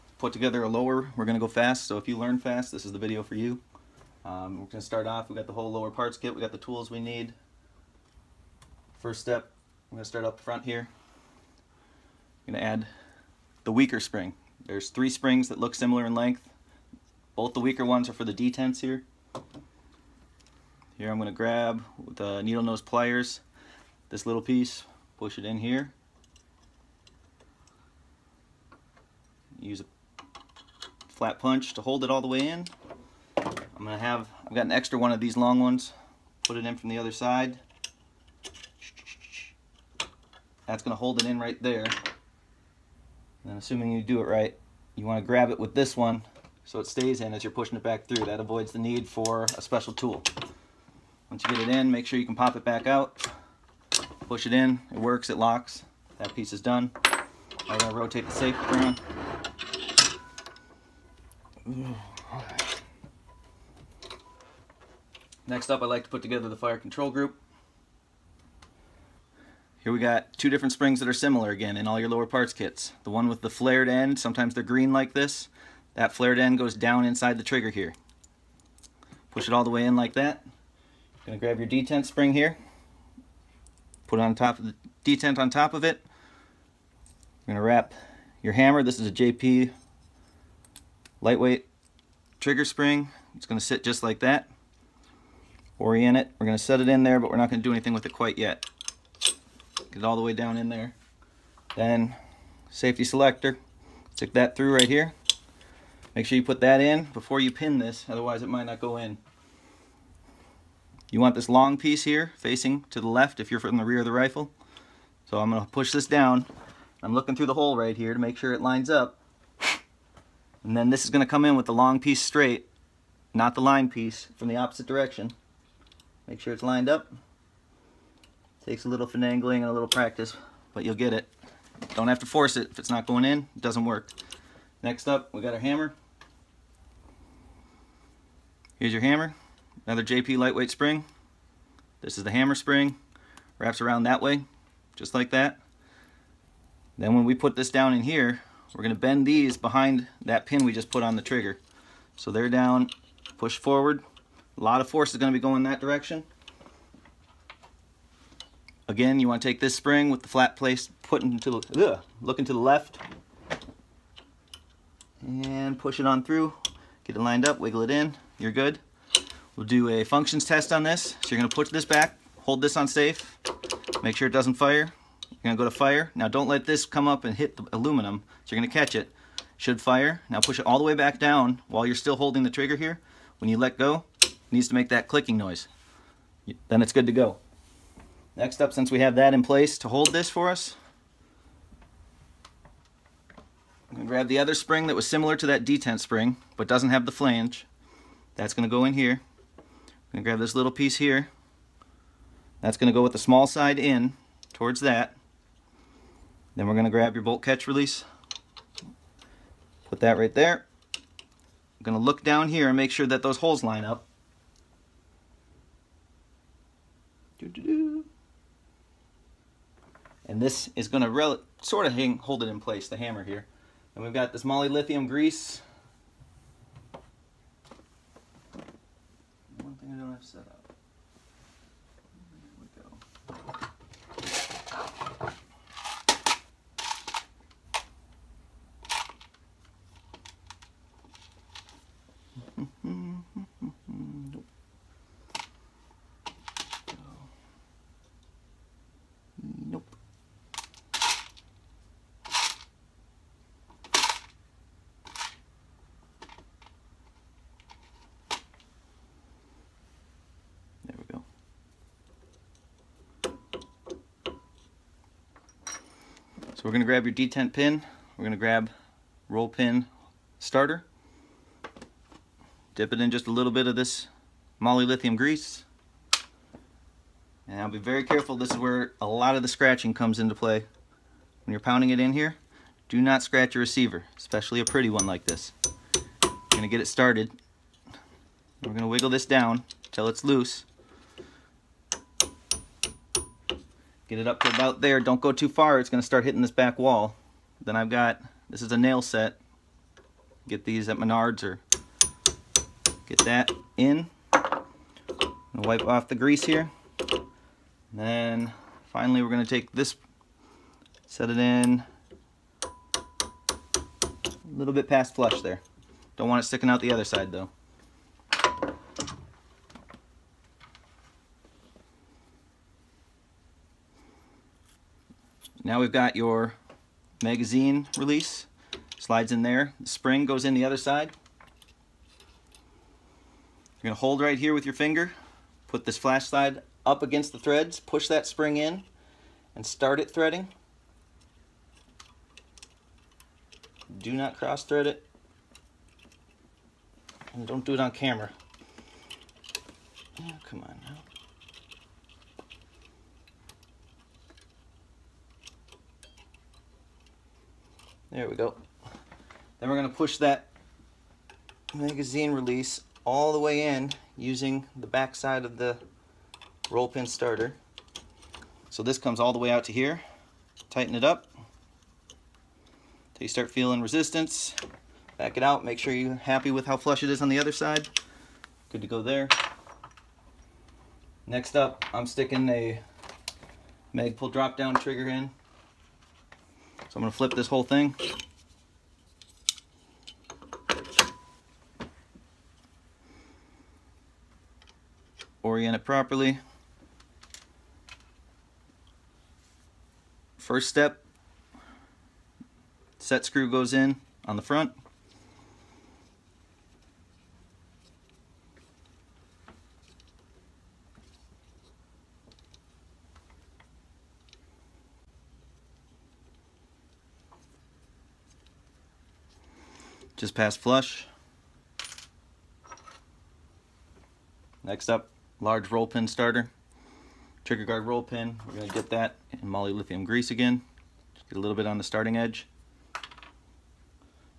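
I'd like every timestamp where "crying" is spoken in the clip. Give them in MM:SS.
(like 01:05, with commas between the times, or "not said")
not said.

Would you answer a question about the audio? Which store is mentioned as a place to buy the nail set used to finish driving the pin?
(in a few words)
Menards.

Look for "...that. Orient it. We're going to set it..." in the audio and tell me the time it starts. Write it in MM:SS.
01:34.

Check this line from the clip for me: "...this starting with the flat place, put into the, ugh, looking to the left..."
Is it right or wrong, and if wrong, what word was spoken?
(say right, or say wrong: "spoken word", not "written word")
wrong: "spring", not "starting".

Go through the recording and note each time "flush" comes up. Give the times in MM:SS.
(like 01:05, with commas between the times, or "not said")
05:15, 06:16, 07:00.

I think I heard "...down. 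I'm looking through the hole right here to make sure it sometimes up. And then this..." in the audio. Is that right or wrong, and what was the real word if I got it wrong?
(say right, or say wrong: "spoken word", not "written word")
wrong: "lines", not "sometimes".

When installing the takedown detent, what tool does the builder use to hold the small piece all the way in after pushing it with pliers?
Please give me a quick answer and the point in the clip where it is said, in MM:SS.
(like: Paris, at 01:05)
Flat punch, at 00:31.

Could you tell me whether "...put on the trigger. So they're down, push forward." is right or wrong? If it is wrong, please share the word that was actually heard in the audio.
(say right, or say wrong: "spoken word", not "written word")
right.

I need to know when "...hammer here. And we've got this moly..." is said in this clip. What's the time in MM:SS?
03:42.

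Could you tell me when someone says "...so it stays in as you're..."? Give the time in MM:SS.
00:46.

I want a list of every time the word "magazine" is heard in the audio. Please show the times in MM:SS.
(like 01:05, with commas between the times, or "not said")
05:27, 06:01.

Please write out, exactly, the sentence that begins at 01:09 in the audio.
Here we got two different springs that are similar again in all your lower parts kits.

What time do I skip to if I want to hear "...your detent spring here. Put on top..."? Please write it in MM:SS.
01:21.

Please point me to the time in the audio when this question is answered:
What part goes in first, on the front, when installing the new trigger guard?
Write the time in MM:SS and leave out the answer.
06:42.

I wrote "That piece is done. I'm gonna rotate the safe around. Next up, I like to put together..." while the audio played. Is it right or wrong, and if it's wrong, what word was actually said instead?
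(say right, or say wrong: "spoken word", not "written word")
right.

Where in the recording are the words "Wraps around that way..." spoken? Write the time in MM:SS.
02:23.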